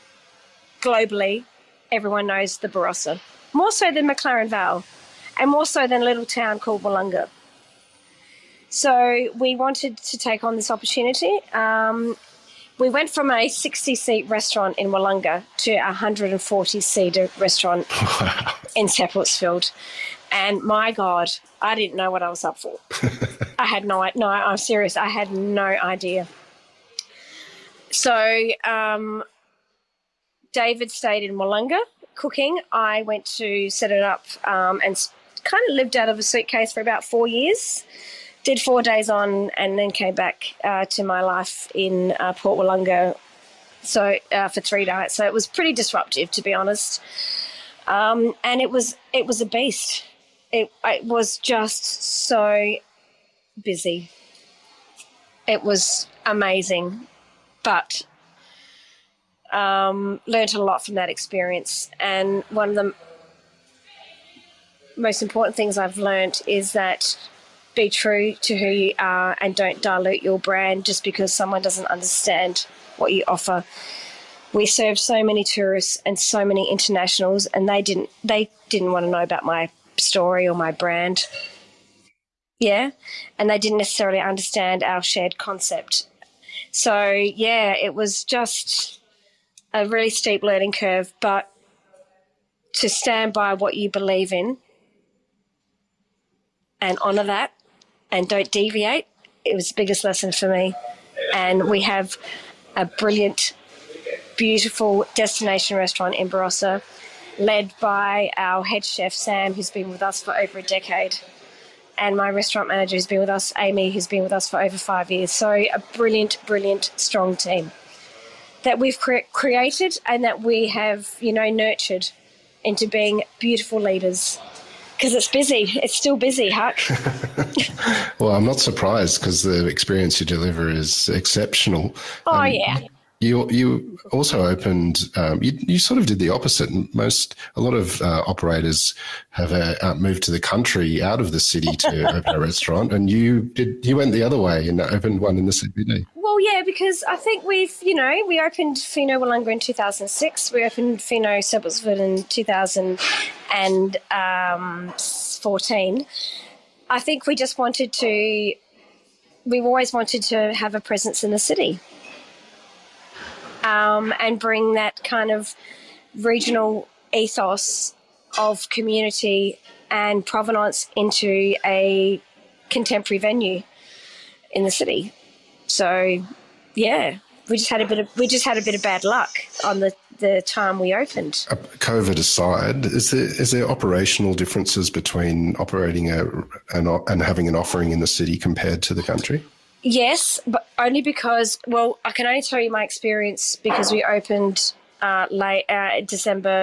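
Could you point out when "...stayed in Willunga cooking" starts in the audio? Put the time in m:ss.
0:30.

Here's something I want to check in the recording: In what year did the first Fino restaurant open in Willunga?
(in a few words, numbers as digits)
2006.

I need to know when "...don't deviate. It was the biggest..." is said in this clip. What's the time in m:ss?
1:38.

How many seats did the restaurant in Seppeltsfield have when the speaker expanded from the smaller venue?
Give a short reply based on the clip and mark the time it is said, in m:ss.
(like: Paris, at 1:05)
140, at 0:15.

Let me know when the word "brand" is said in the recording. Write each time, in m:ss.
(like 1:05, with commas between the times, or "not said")
1:10, 1:20.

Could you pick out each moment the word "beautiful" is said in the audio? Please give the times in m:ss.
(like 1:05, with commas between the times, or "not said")
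1:44, 2:03.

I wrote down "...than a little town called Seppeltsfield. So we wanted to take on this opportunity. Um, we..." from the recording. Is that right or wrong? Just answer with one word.
wrong.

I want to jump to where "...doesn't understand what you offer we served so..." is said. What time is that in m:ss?
1:11.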